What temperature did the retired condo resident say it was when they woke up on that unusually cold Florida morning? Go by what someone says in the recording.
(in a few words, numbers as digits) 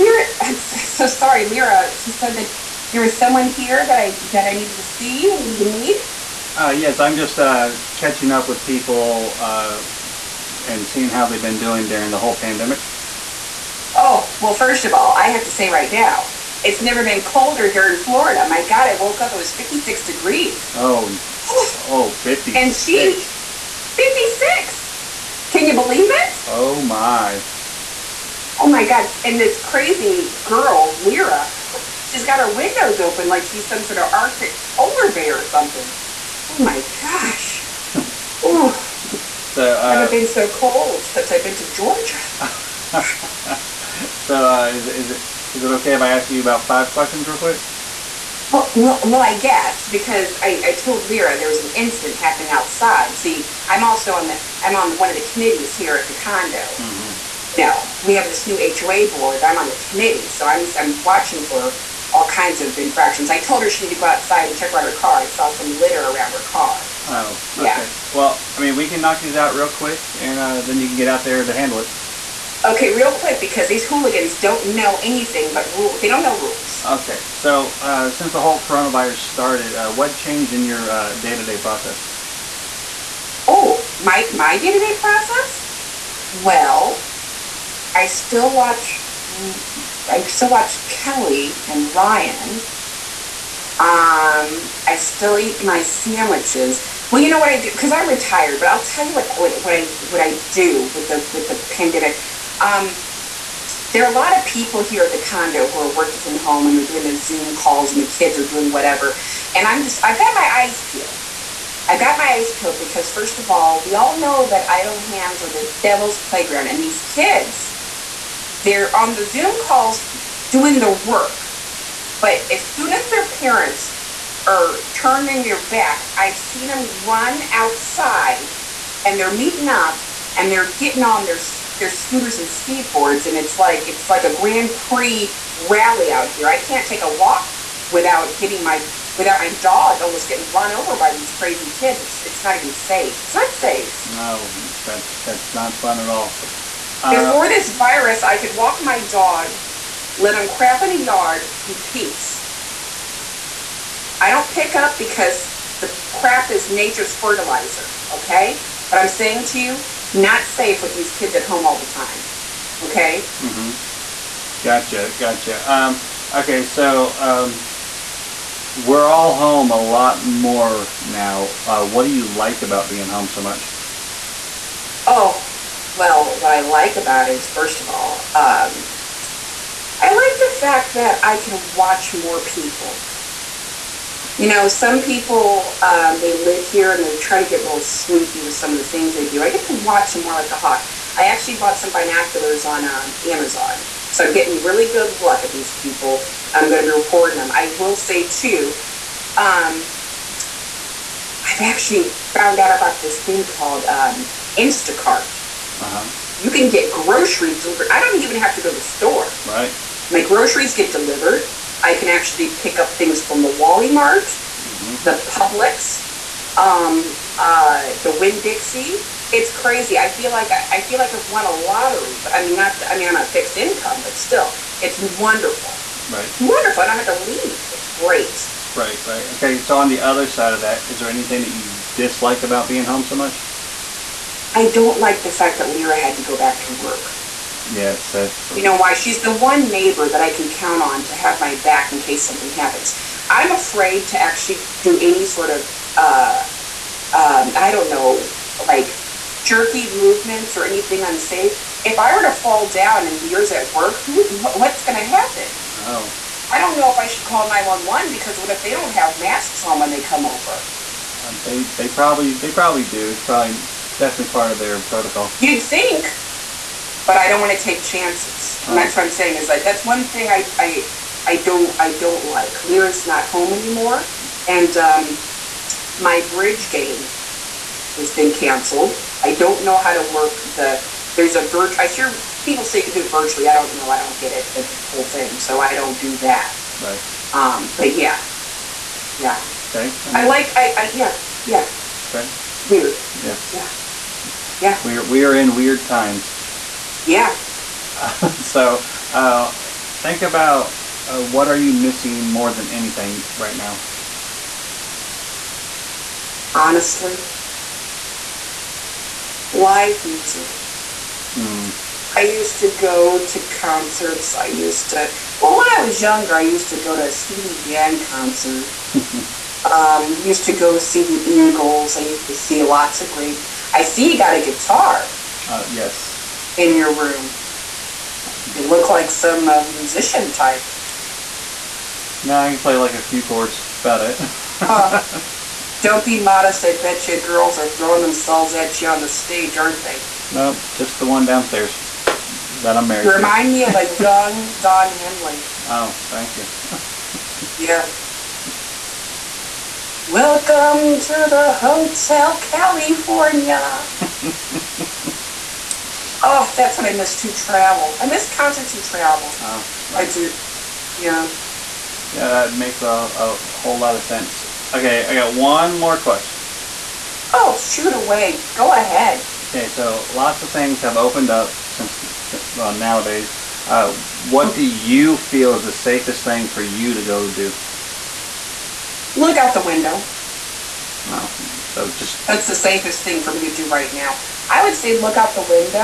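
56 degrees.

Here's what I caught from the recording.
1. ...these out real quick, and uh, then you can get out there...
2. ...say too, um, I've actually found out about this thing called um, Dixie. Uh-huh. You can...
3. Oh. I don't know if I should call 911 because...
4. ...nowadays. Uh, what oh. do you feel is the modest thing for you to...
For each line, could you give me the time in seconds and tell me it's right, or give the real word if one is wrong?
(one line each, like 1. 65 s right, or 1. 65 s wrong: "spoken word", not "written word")
1. 69 s right
2. 197 s wrong: "Instacart", not "Dixie"
3. 255 s right
4. 372 s wrong: "safest", not "modest".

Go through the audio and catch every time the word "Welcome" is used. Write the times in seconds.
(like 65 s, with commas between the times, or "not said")
350 s.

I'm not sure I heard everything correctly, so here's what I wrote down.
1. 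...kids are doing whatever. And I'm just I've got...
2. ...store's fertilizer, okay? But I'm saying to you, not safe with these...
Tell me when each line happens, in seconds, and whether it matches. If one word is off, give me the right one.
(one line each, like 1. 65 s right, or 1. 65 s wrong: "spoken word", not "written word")
1. 108 s right
2. 156 s wrong: "nature", not "store".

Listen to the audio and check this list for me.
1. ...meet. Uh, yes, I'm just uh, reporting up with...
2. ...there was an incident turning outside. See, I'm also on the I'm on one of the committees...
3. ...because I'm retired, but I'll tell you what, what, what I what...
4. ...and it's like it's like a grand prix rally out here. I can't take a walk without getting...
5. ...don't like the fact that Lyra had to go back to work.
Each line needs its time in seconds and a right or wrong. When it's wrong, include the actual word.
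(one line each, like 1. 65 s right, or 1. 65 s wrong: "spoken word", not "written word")
1. 5 s wrong: "catching", not "reporting"
2. 51 s wrong: "happening", not "turning"
3. 97 s right
4. 133 s right
5. 234 s right.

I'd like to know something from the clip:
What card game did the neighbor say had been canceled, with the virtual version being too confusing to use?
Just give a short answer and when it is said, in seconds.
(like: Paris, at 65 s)
Bridge, at 276 s.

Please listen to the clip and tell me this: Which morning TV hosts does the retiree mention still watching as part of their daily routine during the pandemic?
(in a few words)
Kelly and Ryan.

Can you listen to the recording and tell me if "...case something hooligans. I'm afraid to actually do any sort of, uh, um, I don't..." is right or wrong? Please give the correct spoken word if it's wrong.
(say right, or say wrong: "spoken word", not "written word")
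wrong: "happens", not "hooligans".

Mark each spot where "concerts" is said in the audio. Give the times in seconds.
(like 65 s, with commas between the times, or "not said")
313 s, 318 s, 358 s.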